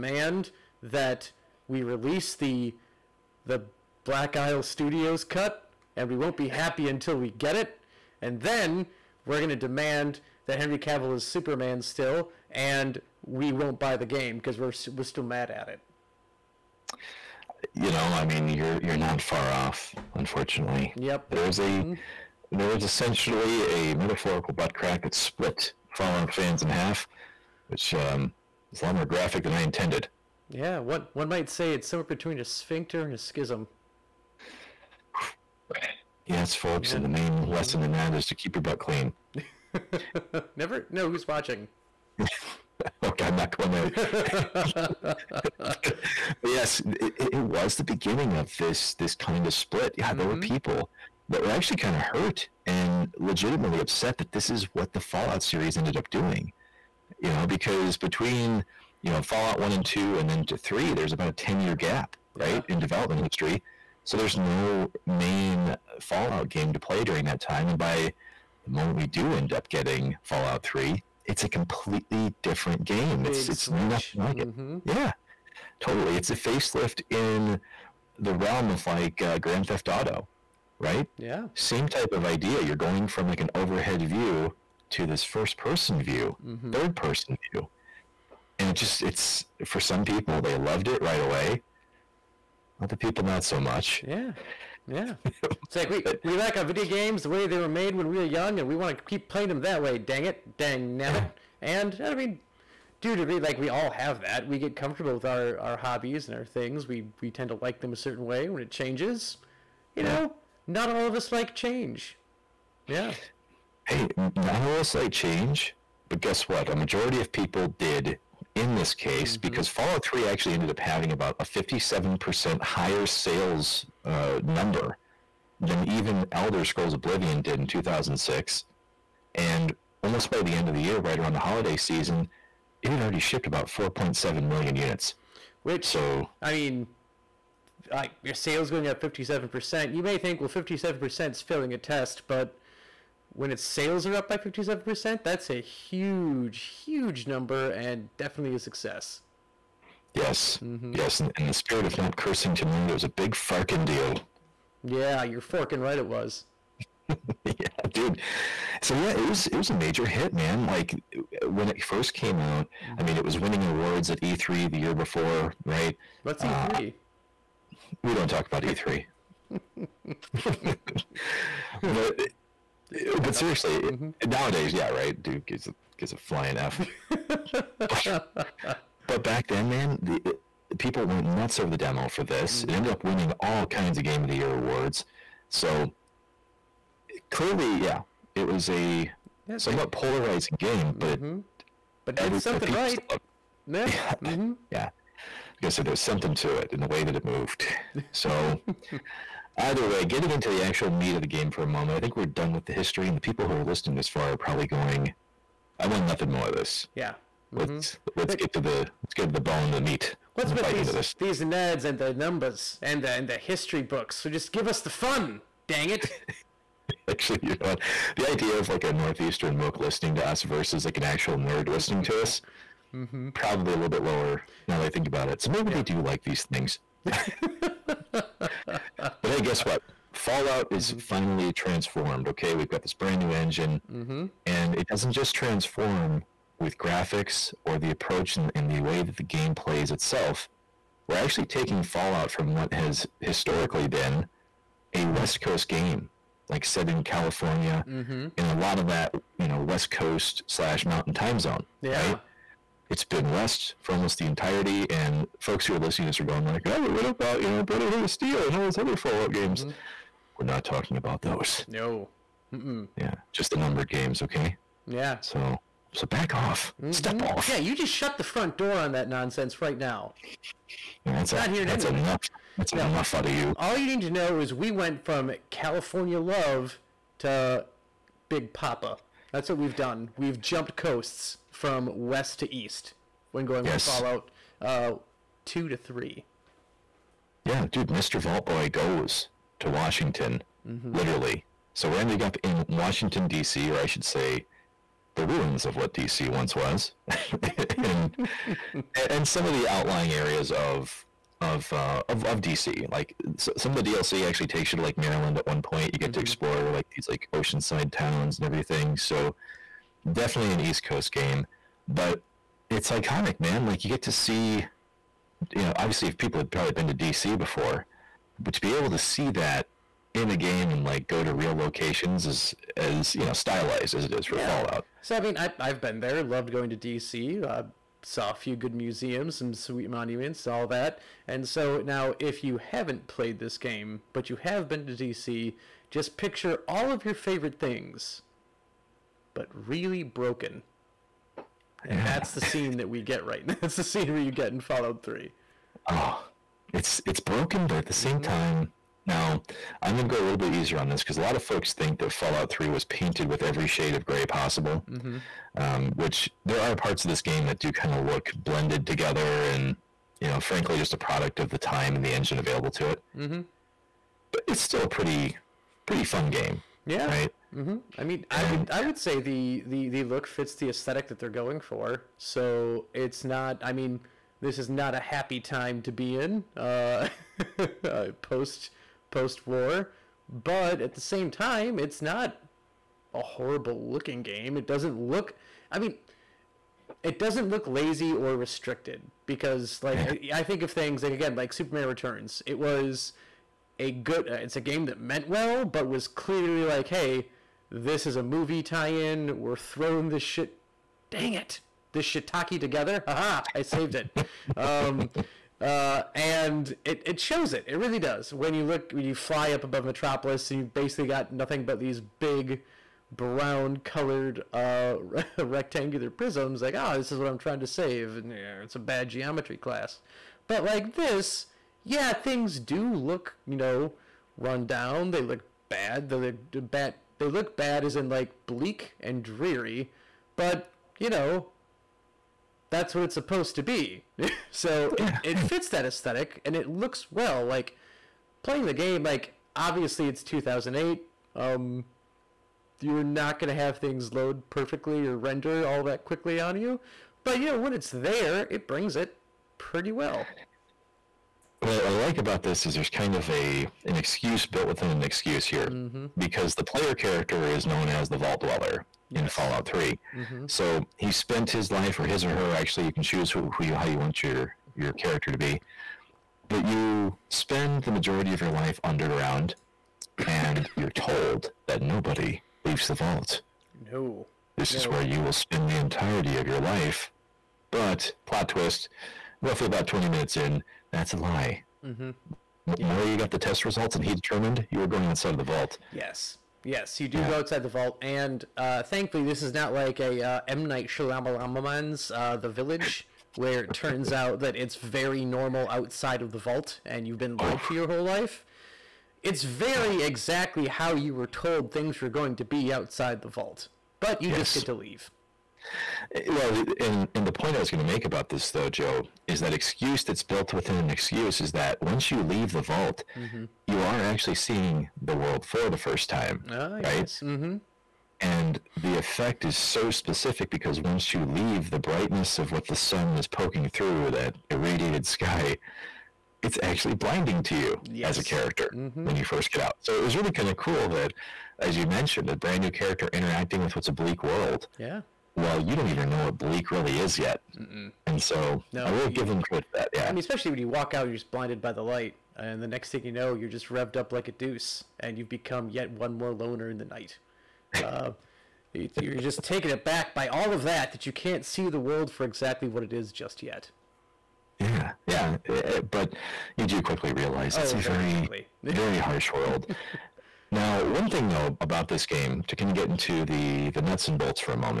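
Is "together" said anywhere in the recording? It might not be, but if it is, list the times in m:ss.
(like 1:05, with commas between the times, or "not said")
5:58, 6:42.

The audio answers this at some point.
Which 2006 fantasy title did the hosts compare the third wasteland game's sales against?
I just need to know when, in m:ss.
2:06.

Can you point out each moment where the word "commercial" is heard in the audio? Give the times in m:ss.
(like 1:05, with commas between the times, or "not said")
not said.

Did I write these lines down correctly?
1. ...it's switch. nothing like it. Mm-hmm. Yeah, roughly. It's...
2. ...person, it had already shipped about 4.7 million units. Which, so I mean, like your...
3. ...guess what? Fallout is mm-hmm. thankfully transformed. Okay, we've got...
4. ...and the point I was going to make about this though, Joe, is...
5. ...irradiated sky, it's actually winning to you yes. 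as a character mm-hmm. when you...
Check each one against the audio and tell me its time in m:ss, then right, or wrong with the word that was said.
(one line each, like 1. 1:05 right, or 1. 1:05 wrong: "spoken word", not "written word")
1. 1:13 wrong: "totally", not "roughly"
2. 2:11 wrong: "season", not "person"
3. 3:49 wrong: "finally", not "thankfully"
4. 8:27 right
5. 8:44 wrong: "blinding", not "winning".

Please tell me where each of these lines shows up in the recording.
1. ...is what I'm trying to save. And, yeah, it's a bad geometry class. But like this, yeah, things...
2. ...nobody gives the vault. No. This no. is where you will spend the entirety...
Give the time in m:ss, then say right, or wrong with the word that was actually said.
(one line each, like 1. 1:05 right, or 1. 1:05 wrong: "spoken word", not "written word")
1. 6:57 right
2. 7:51 wrong: "leaves", not "gives".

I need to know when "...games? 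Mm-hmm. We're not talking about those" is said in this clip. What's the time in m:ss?
4:19.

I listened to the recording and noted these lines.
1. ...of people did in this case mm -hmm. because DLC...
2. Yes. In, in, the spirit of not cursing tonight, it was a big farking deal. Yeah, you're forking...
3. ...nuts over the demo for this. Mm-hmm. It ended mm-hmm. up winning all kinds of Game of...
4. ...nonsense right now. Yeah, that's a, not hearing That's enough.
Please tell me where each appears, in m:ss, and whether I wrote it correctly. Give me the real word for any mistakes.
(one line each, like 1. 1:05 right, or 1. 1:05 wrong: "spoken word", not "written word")
1. 1:57 wrong: "Fallout", not "DLC"
2. 2:30 right
3. 3:01 right
4. 4:29 right.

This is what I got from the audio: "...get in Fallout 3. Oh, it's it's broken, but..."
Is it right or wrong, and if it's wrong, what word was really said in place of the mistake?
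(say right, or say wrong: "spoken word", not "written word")
right.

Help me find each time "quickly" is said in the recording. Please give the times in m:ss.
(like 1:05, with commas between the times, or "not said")
7:26, 9:16.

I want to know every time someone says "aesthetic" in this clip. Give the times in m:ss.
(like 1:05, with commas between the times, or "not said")
6:10, 7:15.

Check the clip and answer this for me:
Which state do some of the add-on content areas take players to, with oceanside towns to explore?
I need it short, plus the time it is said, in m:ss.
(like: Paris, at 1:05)
Maryland, at 5:04.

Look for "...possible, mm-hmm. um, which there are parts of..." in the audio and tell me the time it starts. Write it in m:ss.
5:54.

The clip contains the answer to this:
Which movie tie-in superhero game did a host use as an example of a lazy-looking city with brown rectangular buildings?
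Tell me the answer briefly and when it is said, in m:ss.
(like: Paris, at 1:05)
Superman Returns, at 6:31.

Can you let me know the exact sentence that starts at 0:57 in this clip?
You know, because between you know Fallout one and two, and then to three, there's about a ten year gap, right, yeah.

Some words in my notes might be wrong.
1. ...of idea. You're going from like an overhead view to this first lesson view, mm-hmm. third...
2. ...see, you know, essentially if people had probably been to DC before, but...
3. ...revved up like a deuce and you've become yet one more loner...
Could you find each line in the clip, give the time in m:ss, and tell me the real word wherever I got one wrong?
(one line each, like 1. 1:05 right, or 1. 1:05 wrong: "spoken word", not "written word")
1. 1:22 wrong: "person", not "lesson"
2. 5:14 wrong: "obviously", not "essentially"
3. 9:03 right.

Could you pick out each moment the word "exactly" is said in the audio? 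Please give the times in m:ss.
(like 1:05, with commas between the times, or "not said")
8:20, 9:12.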